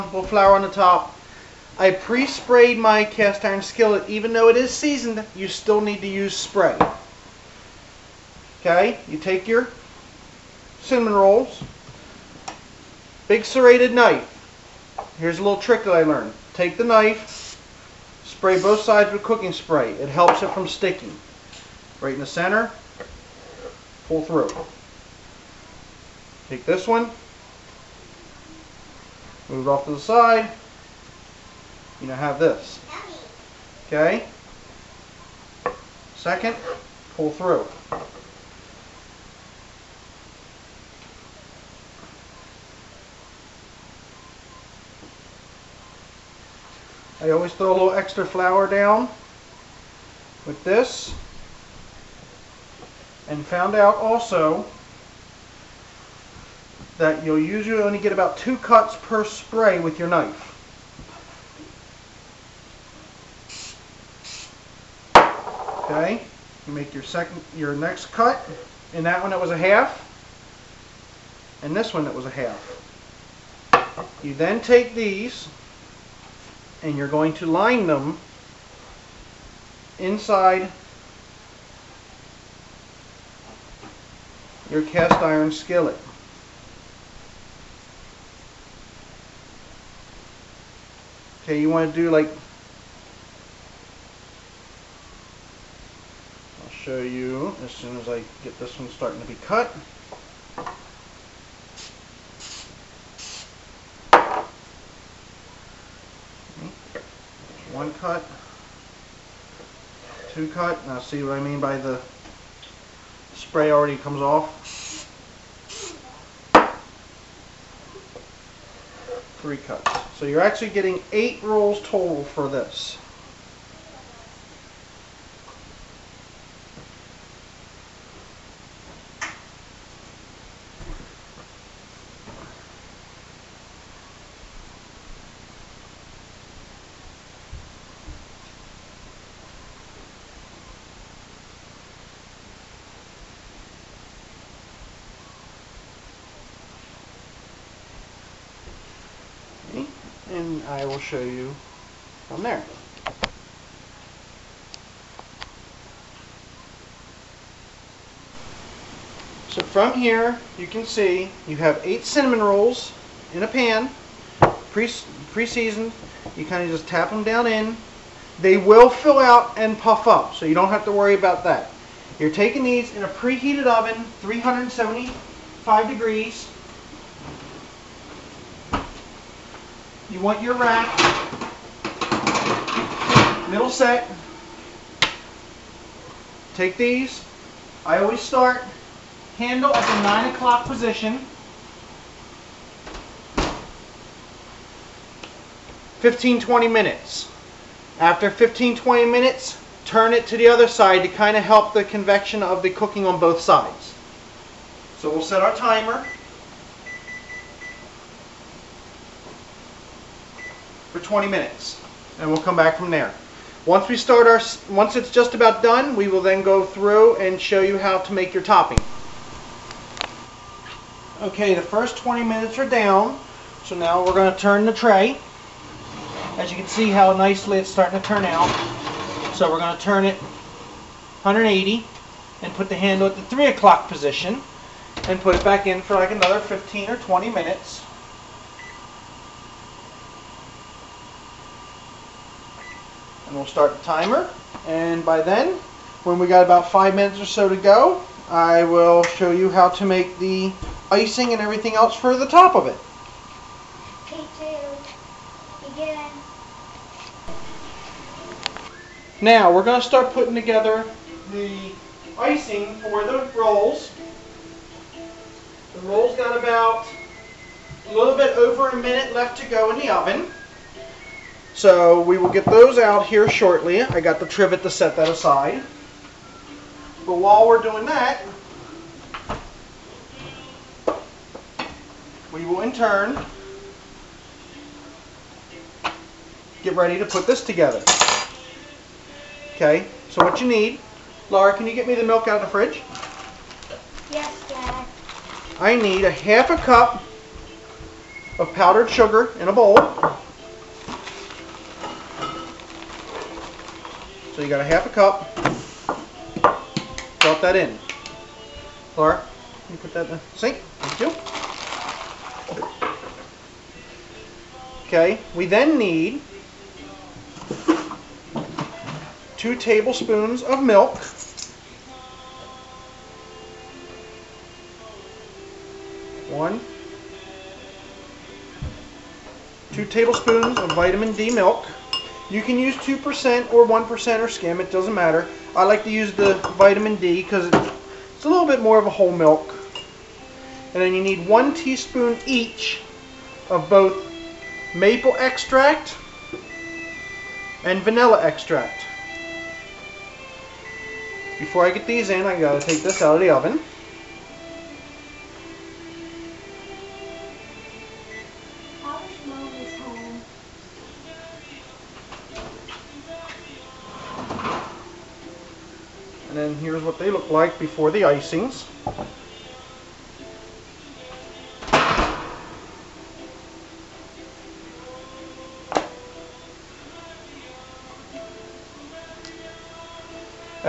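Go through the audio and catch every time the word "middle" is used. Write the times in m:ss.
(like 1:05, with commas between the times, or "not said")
3:03.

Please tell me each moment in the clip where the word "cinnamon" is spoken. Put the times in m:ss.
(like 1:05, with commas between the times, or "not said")
0:10, 2:42.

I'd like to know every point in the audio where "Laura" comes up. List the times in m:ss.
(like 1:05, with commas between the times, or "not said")
4:51, 5:08.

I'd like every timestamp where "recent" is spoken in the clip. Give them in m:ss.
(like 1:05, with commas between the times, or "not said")
not said.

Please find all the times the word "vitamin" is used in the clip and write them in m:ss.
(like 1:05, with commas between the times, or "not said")
5:30, 5:36.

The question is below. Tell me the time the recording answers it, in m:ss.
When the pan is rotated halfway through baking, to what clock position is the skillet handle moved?
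3:53.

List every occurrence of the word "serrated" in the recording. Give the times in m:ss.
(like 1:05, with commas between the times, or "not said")
0:13.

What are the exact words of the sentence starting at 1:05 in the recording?
Okay, you make your second, your next cut.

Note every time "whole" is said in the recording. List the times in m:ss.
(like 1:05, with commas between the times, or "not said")
5:38.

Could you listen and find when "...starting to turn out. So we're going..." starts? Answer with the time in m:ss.
3:47.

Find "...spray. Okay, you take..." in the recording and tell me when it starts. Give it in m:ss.
0:06.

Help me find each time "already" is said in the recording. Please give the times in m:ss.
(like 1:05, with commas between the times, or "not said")
1:53.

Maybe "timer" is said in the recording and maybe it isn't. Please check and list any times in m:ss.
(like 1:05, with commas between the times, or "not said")
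3:25, 4:03.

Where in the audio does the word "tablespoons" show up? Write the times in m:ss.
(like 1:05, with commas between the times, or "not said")
5:19, 5:29.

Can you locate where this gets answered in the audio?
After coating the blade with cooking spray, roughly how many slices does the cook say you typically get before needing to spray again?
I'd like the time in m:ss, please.
0:58.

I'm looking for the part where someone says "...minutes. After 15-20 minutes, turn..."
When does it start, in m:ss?
3:16.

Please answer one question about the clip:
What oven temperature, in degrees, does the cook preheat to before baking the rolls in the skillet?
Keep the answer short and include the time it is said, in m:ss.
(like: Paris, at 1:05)
375, at 2:54.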